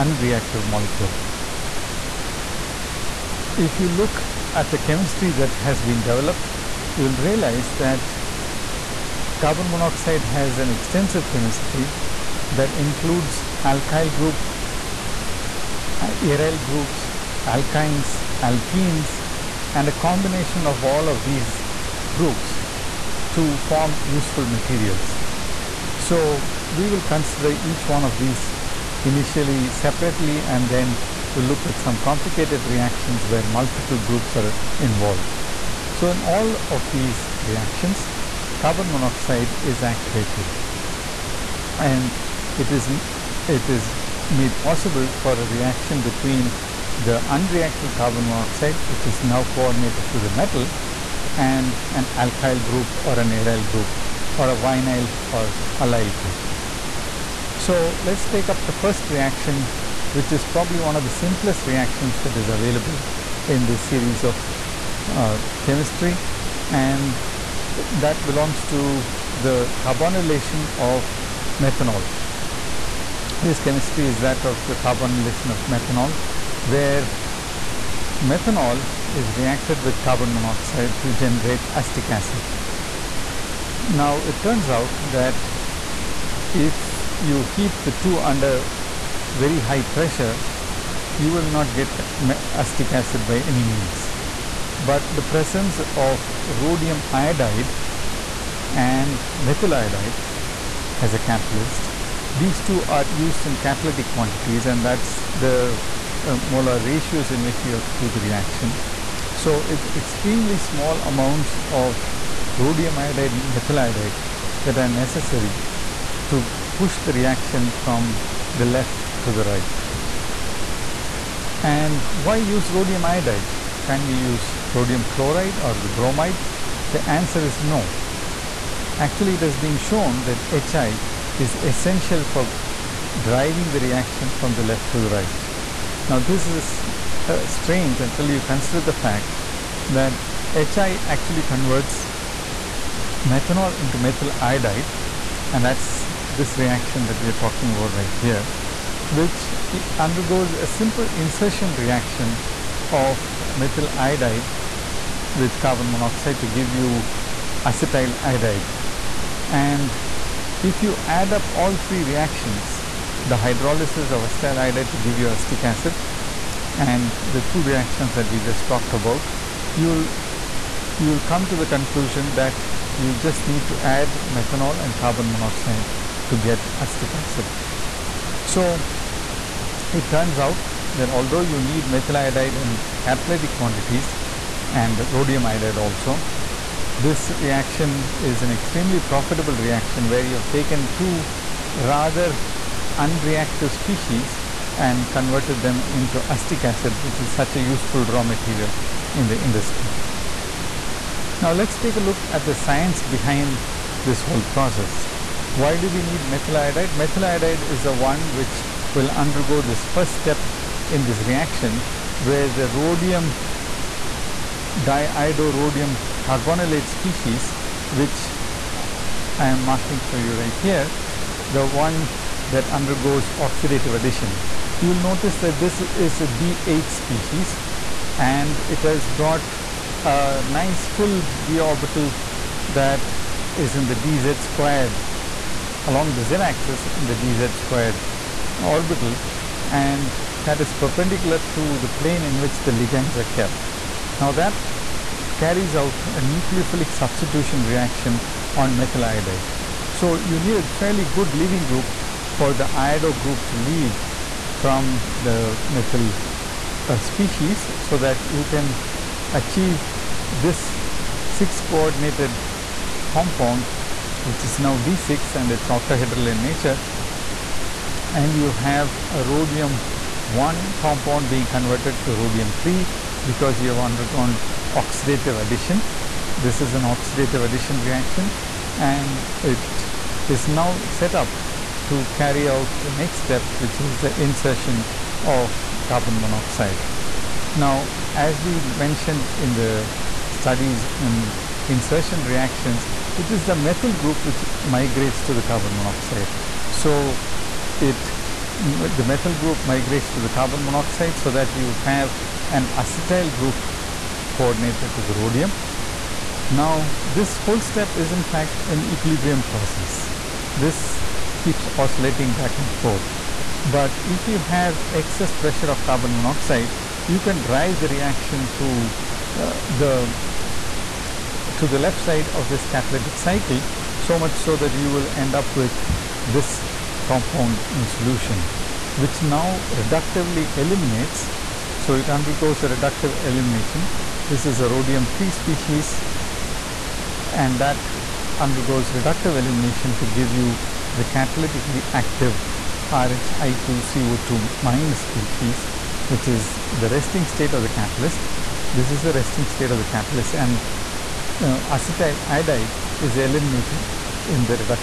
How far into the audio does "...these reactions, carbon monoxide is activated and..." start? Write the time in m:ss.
0:36.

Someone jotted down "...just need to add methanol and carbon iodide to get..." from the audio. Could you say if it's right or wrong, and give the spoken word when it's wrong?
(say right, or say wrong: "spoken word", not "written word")
wrong: "monoxide", not "iodide".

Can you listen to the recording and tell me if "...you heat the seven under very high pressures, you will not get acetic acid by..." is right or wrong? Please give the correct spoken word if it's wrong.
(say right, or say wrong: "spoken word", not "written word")
wrong: "two", not "seven".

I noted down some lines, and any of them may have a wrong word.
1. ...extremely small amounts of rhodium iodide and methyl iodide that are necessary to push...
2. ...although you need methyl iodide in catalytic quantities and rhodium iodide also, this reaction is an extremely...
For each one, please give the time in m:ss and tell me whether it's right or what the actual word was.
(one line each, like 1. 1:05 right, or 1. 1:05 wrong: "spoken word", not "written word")
1. 1:49 right
2. 3:01 right.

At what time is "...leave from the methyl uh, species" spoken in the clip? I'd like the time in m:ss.
4:13.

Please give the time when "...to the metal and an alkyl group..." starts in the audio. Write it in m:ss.
0:50.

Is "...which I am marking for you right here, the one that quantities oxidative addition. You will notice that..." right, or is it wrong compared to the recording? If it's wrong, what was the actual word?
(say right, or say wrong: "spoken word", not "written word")
wrong: "undergoes", not "quantities".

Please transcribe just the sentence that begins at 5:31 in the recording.
So, it undergoes a reductive elimination.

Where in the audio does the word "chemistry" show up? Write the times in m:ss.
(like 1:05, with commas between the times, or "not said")
0:04, 0:11, 1:05, 1:13.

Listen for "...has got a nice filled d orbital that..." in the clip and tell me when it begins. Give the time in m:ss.
3:48.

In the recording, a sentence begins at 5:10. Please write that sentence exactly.
This keeps oscillating back and forth.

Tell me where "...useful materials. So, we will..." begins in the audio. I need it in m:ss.
0:24.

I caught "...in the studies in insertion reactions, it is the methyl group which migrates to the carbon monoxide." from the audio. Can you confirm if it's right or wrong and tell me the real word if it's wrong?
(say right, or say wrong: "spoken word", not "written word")
right.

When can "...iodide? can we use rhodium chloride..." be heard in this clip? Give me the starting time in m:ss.
2:03.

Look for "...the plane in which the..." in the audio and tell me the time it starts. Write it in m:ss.
4:01.